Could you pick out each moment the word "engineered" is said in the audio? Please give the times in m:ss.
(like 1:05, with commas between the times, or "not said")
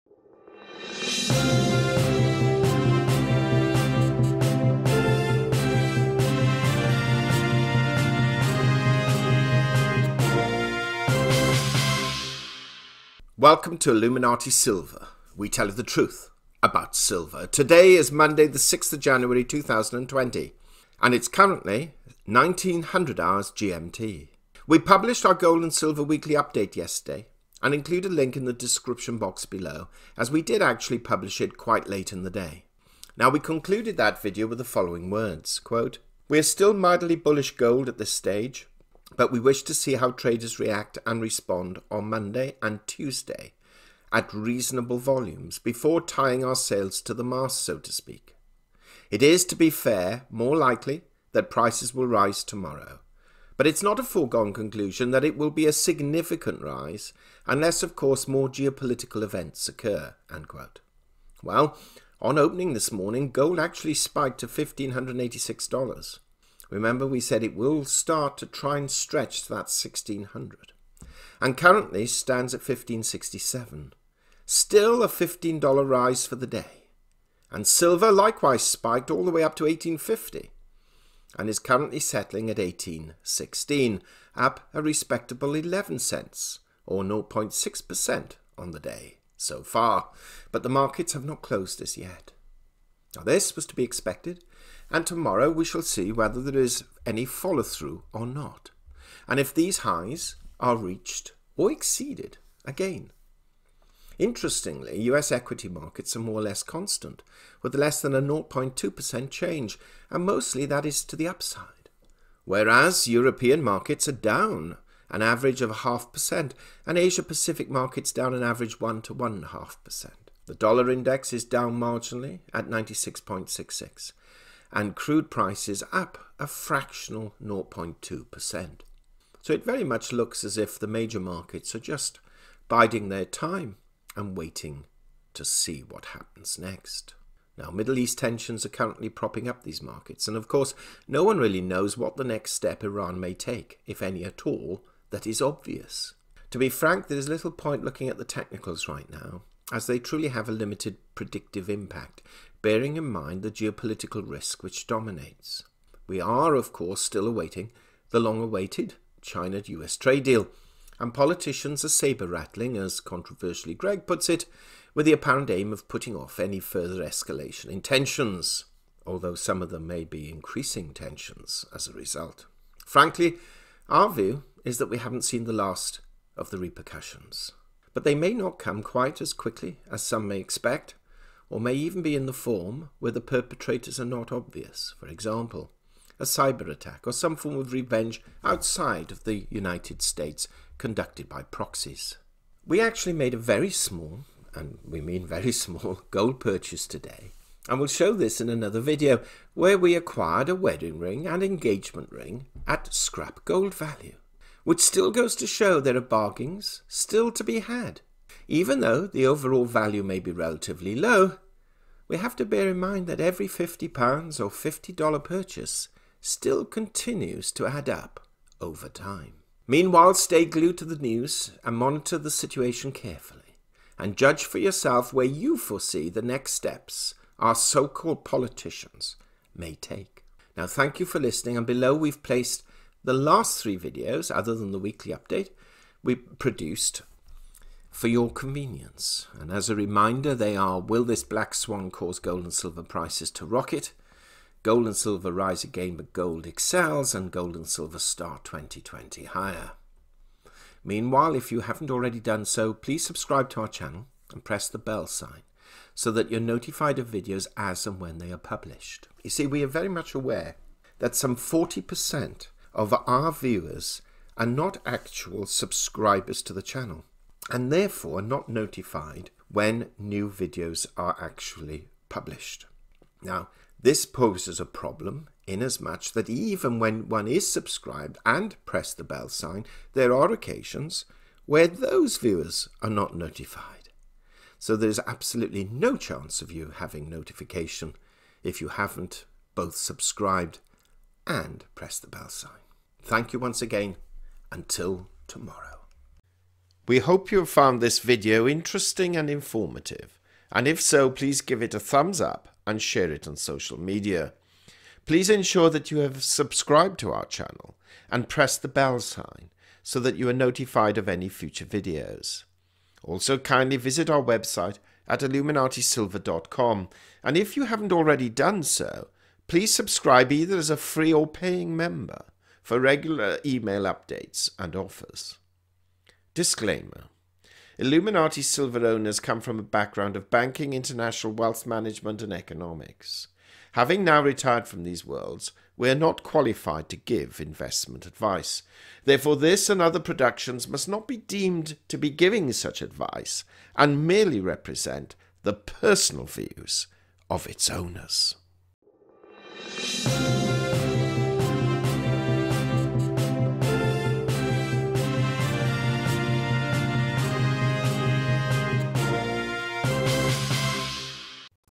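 not said.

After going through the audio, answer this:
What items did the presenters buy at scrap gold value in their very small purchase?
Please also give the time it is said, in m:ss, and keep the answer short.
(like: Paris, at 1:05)
wedding ring and engagement ring, at 3:20.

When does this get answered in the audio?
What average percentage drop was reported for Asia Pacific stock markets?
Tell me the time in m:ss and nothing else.
1:58.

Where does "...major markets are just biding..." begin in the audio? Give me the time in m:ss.
2:10.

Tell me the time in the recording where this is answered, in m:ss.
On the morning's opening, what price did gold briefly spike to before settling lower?
1:04.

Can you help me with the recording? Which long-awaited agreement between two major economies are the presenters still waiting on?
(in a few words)
China-US trade deal.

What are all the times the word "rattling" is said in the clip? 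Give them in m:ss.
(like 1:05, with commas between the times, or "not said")
2:41.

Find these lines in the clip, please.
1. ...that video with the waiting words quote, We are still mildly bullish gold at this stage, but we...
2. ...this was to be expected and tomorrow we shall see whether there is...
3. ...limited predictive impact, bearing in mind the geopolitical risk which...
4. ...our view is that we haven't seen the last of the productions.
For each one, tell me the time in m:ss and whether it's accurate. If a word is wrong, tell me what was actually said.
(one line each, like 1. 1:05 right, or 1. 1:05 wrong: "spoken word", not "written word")
1. 0:33 wrong: "following", not "waiting"
2. 1:33 right
3. 2:30 right
4. 2:53 wrong: "repercussions", not "productions".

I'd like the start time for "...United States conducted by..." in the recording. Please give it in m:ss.
3:09.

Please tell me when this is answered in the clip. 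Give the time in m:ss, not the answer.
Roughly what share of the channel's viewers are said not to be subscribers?
4:21.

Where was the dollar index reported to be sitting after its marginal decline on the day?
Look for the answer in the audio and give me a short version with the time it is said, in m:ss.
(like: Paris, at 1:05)
96.66, at 2:02.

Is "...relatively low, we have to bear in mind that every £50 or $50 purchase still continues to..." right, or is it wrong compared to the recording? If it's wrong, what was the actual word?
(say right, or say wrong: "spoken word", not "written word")
right.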